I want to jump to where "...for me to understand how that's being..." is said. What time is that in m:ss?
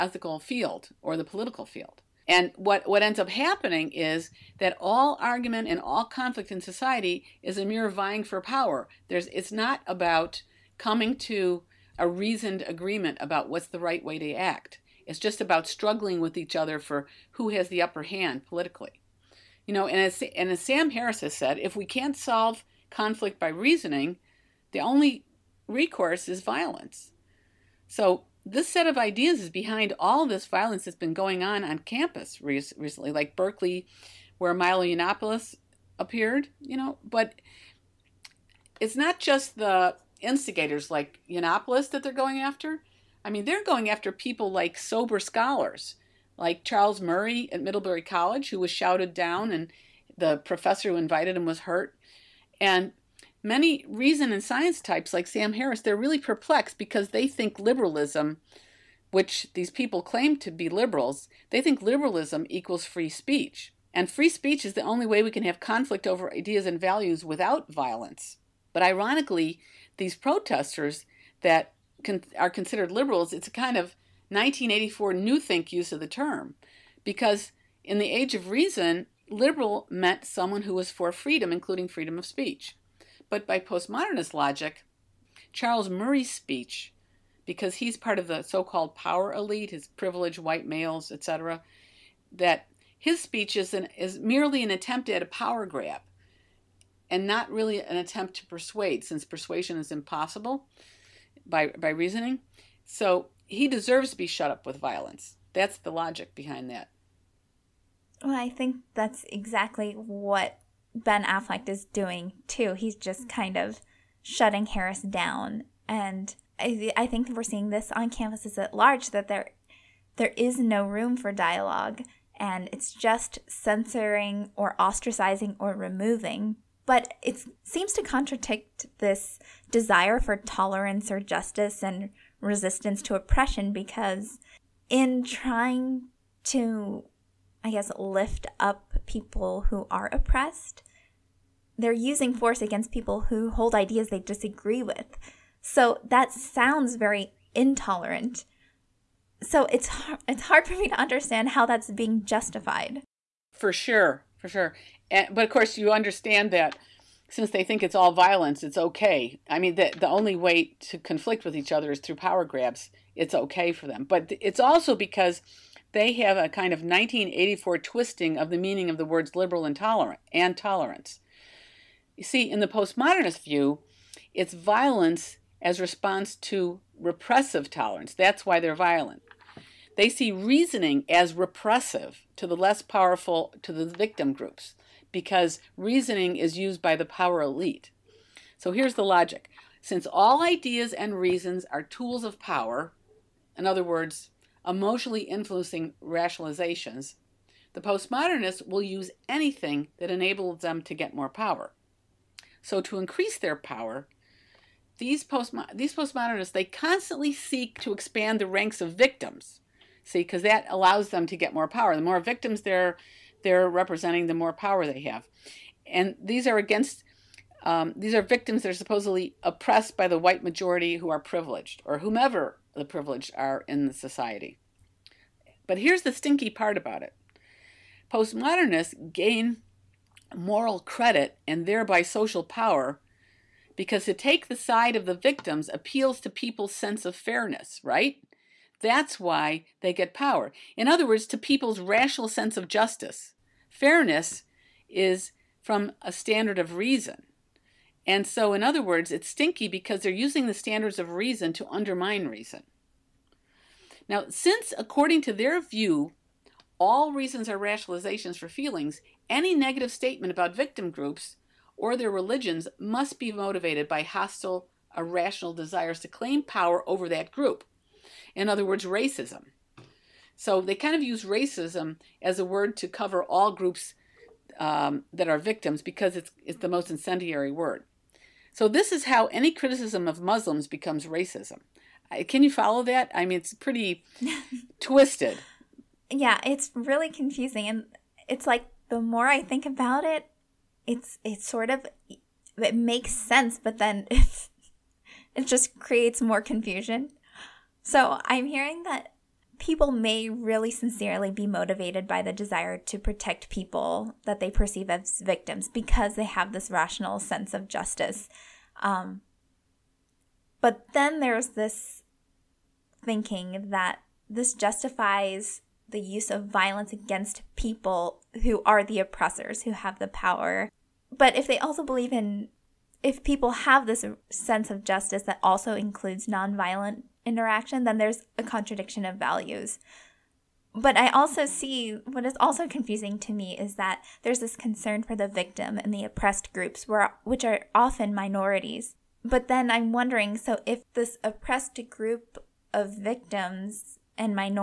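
2:30.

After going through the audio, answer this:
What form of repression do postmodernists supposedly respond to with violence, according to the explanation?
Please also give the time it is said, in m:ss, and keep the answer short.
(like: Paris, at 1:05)
repressive tolerance, at 2:56.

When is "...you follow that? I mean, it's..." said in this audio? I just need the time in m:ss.
4:42.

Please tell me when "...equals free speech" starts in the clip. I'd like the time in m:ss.
1:02.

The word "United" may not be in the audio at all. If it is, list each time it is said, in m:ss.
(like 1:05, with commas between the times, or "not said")
not said.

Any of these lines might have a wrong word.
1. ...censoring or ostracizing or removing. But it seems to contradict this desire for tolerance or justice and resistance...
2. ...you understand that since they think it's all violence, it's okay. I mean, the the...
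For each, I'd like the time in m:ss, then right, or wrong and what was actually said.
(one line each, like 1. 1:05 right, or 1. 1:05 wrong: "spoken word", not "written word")
1. 2:03 right
2. 2:35 right.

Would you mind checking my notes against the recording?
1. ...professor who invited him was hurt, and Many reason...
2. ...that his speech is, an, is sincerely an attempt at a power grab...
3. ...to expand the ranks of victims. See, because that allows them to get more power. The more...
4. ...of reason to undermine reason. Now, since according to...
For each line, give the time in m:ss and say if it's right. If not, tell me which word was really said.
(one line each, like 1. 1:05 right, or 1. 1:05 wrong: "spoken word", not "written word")
1. 0:50 right
2. 1:32 wrong: "merely", not "sincerely"
3. 3:27 right
4. 4:10 right.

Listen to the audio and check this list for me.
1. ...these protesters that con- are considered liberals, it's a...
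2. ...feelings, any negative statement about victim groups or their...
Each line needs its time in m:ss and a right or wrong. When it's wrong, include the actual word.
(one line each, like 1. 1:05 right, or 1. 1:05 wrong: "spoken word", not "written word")
1. 1:09 right
2. 4:18 right.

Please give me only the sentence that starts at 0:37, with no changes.
But it's not just the instigators like Yiannopoulos that they're going after.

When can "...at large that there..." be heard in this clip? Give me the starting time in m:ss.
1:58.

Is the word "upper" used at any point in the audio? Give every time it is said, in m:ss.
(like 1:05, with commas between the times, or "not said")
0:17.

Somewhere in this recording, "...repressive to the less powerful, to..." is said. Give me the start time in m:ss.
3:01.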